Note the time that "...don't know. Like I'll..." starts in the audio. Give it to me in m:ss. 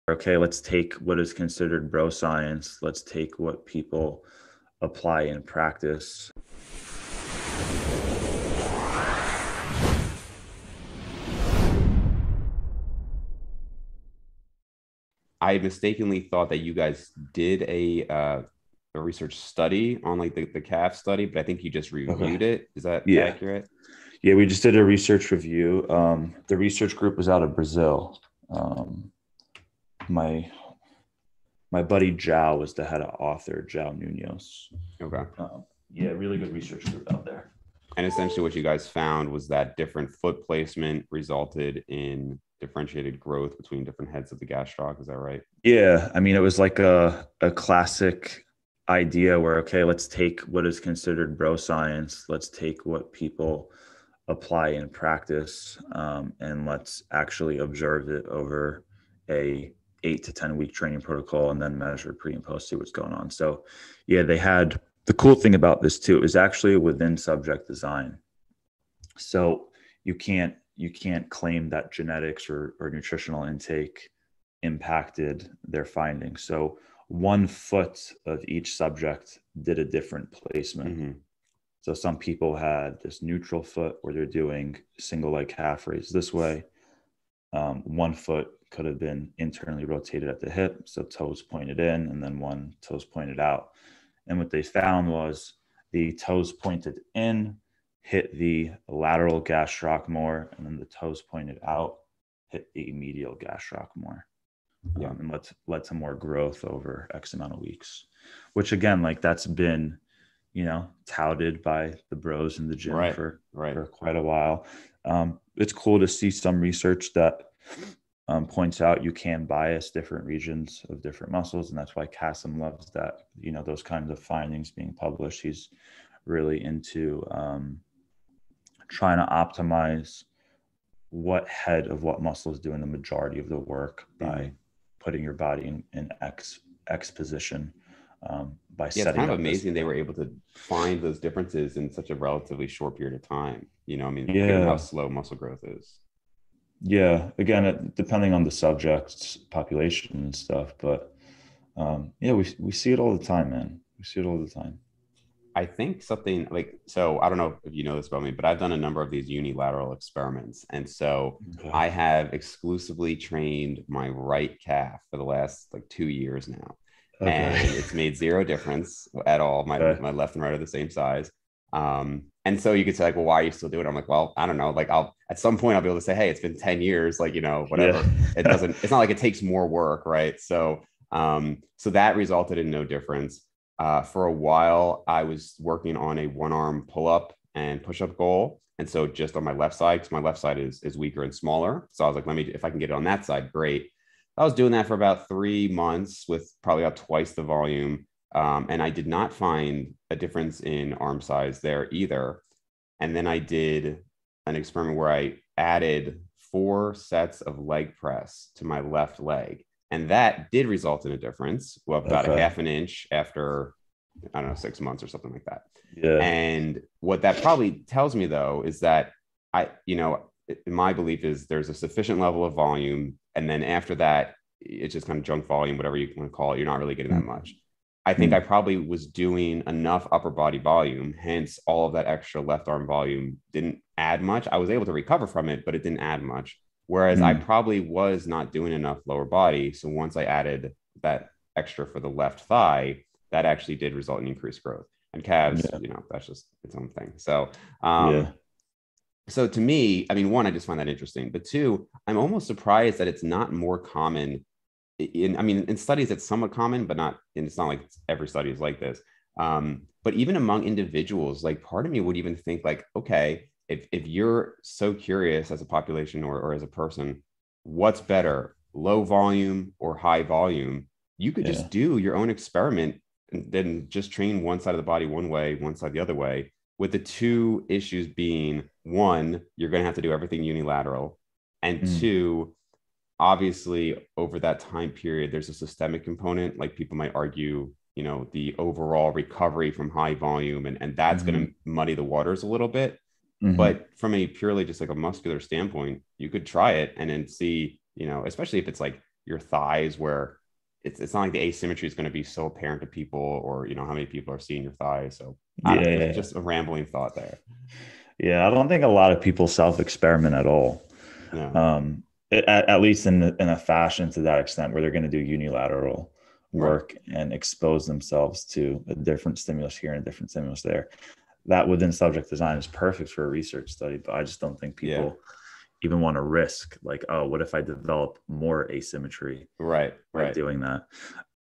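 2:54.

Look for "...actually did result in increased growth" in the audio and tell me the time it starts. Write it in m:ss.
4:03.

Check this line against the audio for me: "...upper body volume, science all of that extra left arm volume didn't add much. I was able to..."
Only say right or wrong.
wrong.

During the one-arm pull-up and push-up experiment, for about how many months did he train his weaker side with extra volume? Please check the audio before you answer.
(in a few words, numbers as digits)
3.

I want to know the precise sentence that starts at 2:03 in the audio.
You know those kinds of findings being published.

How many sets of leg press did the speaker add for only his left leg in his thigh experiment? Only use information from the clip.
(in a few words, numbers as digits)
4.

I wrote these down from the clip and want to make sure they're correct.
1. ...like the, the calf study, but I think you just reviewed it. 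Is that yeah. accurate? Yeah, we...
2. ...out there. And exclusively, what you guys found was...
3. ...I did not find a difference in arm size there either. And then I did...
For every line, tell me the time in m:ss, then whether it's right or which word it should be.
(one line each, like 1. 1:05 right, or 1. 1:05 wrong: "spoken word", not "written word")
1. 0:20 right
2. 0:37 wrong: "essentially", not "exclusively"
3. 3:18 right.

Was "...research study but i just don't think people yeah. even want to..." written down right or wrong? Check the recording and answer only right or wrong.
right.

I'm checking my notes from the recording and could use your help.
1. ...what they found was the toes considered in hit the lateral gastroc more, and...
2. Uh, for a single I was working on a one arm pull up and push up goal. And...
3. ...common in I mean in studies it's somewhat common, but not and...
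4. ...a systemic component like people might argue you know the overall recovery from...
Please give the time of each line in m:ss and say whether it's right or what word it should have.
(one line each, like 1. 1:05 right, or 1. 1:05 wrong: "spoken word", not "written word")
1. 1:34 wrong: "pointed", not "considered"
2. 3:03 wrong: "while", not "single"
3. 4:13 right
4. 4:45 right.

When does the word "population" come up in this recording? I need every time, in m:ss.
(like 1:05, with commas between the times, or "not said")
2:29, 4:25.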